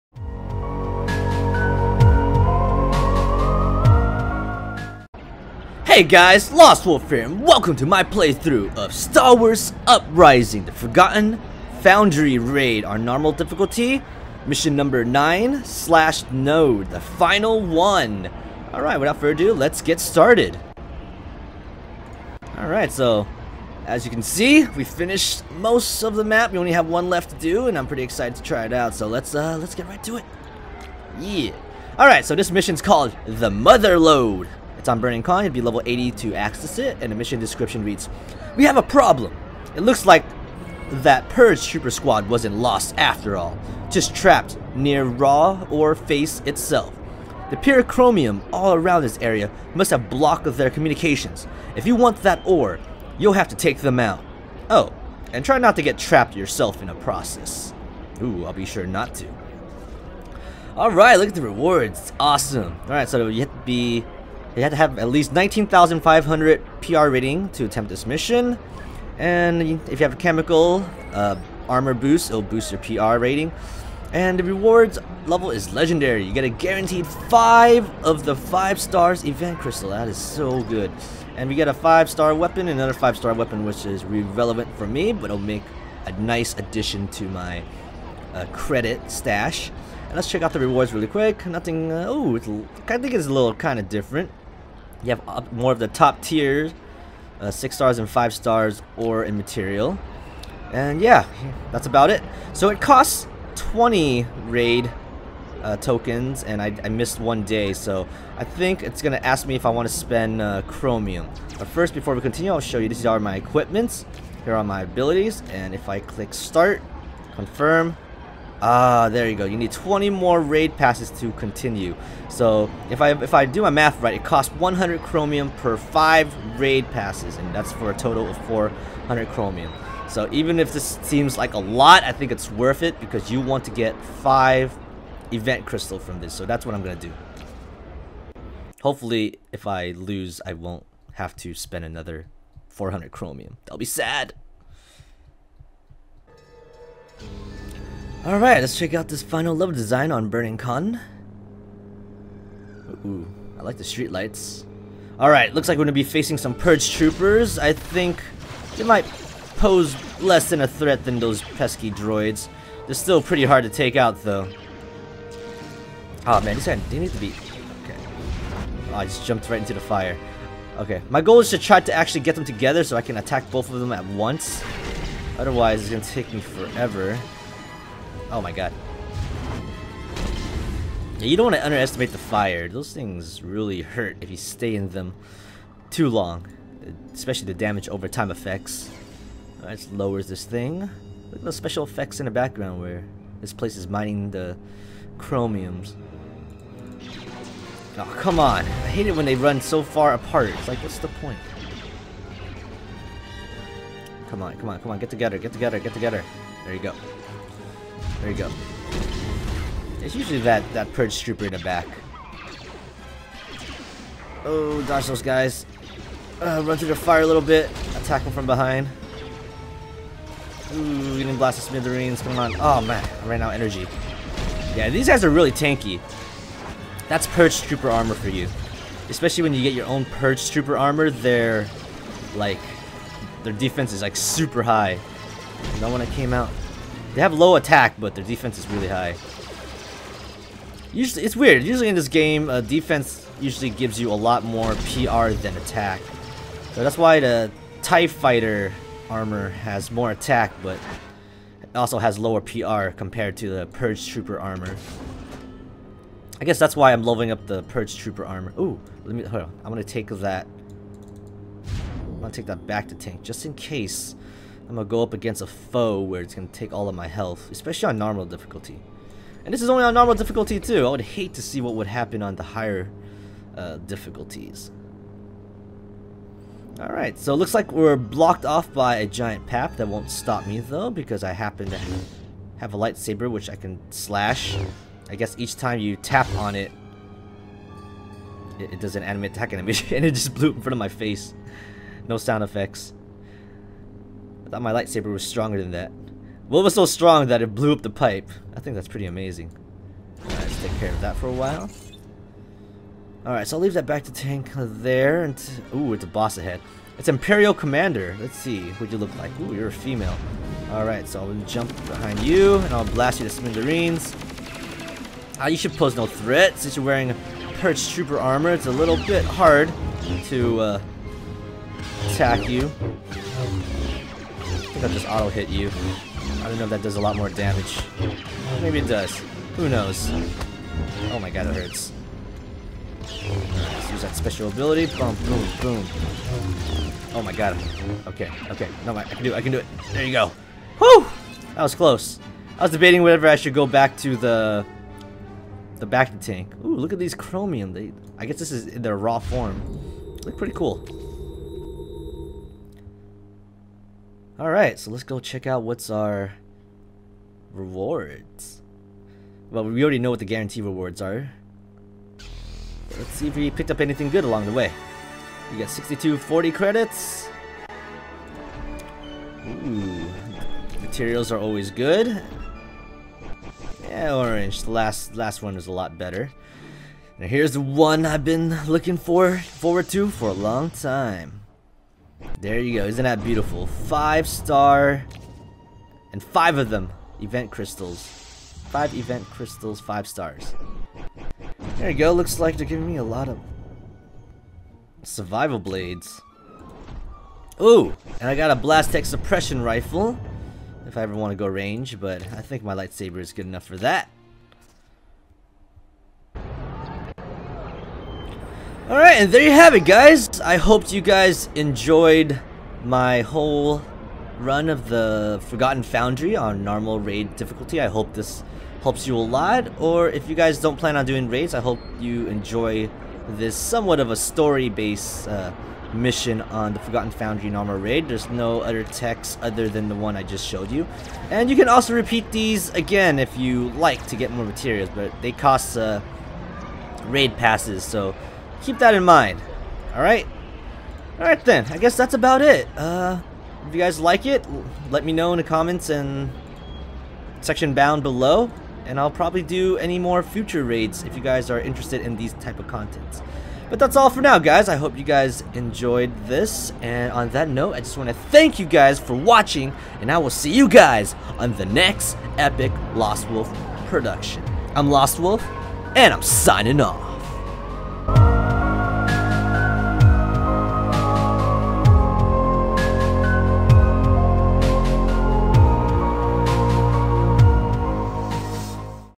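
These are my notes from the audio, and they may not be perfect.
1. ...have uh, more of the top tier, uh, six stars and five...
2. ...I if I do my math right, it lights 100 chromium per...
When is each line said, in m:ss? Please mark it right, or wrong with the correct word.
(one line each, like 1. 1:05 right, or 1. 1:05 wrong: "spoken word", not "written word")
1. 1:35 right
2. 2:03 wrong: "costs", not "lights".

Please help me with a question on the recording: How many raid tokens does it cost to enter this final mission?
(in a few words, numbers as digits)
20.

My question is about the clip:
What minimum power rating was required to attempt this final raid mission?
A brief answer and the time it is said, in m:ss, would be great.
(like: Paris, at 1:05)
19,500, at 1:05.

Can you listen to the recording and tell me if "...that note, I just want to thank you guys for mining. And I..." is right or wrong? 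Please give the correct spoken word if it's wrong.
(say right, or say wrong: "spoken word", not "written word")
wrong: "watching", not "mining".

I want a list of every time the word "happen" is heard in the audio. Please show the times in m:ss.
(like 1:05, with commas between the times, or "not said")
4:31, 4:41.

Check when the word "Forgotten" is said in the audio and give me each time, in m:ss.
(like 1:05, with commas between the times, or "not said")
0:10, 6:55, 7:06.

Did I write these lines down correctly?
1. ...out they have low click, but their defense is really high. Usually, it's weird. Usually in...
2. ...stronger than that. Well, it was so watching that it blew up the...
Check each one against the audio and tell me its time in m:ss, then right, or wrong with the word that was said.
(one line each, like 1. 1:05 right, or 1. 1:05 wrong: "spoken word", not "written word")
1. 3:56 wrong: "attack", not "click"
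2. 4:55 wrong: "strong", not "watching".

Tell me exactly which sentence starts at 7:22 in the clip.
Uh, if you guys like it, let me know in the comments and section down below.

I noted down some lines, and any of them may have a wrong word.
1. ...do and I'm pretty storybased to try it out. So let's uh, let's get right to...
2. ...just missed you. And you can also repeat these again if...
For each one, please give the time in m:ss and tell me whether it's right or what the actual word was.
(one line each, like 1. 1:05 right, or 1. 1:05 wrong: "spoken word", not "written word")
1. 0:27 wrong: "excited", not "storybased"
2. 7:10 wrong: "showed", not "missed".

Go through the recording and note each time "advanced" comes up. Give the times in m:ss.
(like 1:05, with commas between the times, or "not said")
not said.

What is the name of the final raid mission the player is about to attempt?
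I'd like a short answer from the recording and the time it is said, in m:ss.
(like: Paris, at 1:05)
The Motherlode, at 0:33.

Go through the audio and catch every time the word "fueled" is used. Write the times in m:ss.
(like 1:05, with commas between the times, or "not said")
not said.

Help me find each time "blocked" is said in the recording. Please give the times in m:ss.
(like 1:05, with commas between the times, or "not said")
0:50, 4:37.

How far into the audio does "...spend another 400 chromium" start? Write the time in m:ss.
2:21.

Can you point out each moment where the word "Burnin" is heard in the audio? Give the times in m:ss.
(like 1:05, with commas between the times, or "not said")
0:34, 2:30.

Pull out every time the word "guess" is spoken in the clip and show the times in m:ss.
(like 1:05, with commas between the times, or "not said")
4:16, 4:45, 5:48, 7:21.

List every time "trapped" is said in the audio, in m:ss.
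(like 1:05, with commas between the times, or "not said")
0:44, 0:55.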